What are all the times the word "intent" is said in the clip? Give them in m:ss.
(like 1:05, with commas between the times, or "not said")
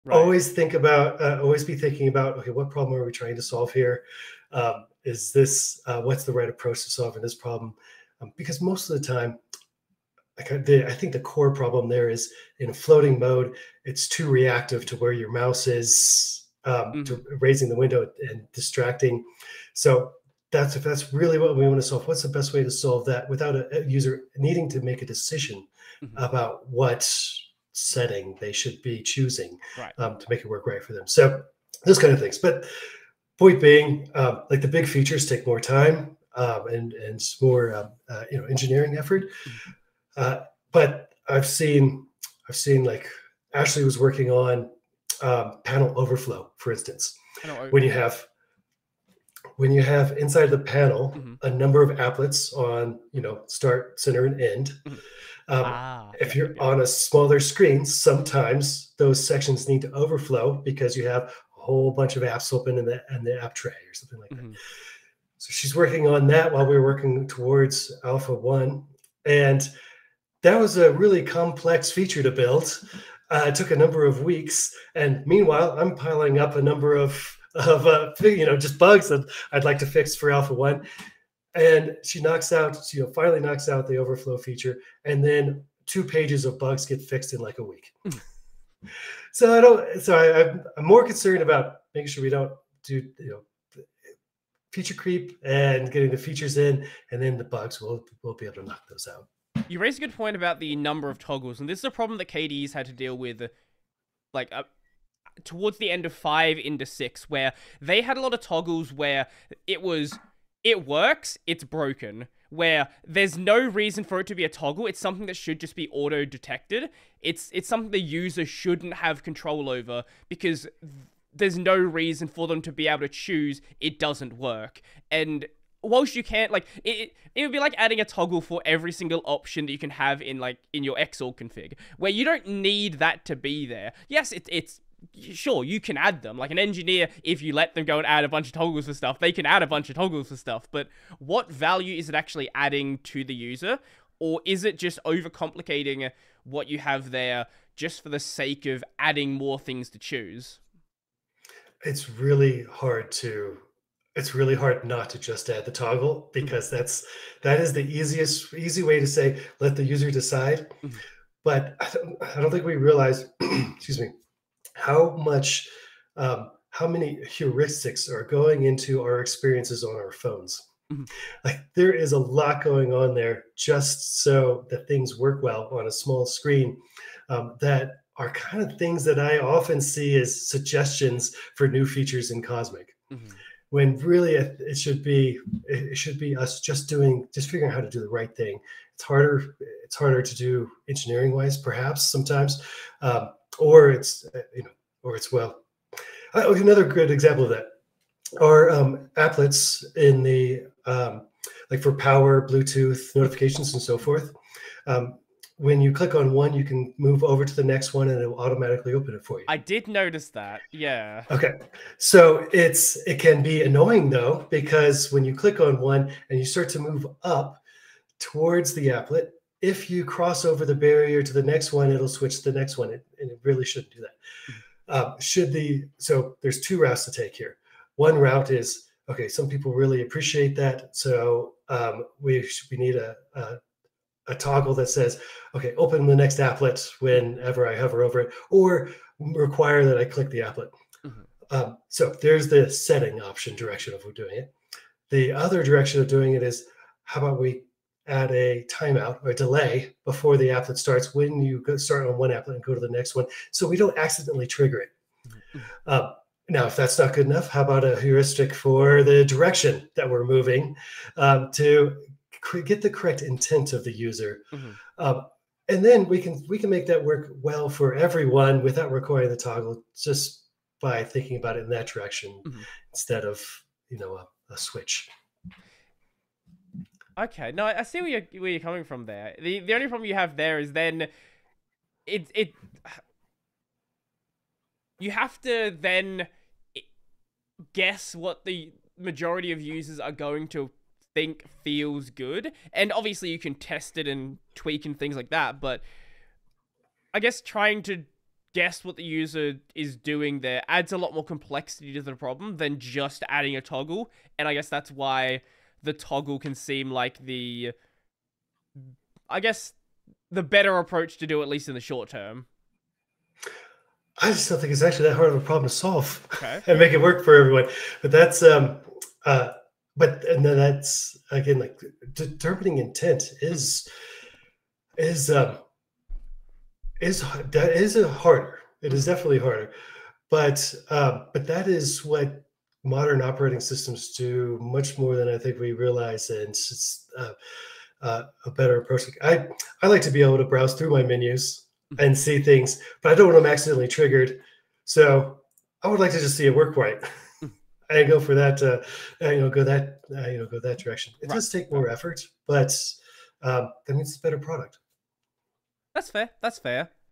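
4:23, 5:22.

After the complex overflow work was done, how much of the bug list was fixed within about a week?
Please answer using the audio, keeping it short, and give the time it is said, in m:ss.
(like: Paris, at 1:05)
two pages, at 1:25.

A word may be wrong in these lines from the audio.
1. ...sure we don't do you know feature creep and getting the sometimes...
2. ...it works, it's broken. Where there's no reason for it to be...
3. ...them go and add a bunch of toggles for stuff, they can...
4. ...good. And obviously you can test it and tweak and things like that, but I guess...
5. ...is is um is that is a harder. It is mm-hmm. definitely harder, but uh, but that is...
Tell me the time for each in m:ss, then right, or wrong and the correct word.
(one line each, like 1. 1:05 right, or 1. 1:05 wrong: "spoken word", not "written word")
1. 1:32 wrong: "features", not "sometimes"
2. 1:50 right
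3. 2:17 right
4. 4:52 right
5. 5:23 right.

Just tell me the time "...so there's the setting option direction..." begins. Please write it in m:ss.
4:01.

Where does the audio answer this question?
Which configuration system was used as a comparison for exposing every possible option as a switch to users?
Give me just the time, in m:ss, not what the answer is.
2:10.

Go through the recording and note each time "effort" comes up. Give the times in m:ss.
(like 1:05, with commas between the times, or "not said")
0:38, 5:51.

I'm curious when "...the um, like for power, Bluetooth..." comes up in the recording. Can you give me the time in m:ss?
3:20.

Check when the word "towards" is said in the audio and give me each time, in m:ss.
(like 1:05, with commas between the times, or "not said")
1:07, 1:45, 3:38.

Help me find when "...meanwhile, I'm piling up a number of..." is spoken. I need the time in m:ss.
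1:15.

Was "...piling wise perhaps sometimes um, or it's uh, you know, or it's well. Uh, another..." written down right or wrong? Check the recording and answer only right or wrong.
wrong.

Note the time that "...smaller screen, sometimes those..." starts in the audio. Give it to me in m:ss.
0:56.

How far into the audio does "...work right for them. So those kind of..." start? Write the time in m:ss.
0:30.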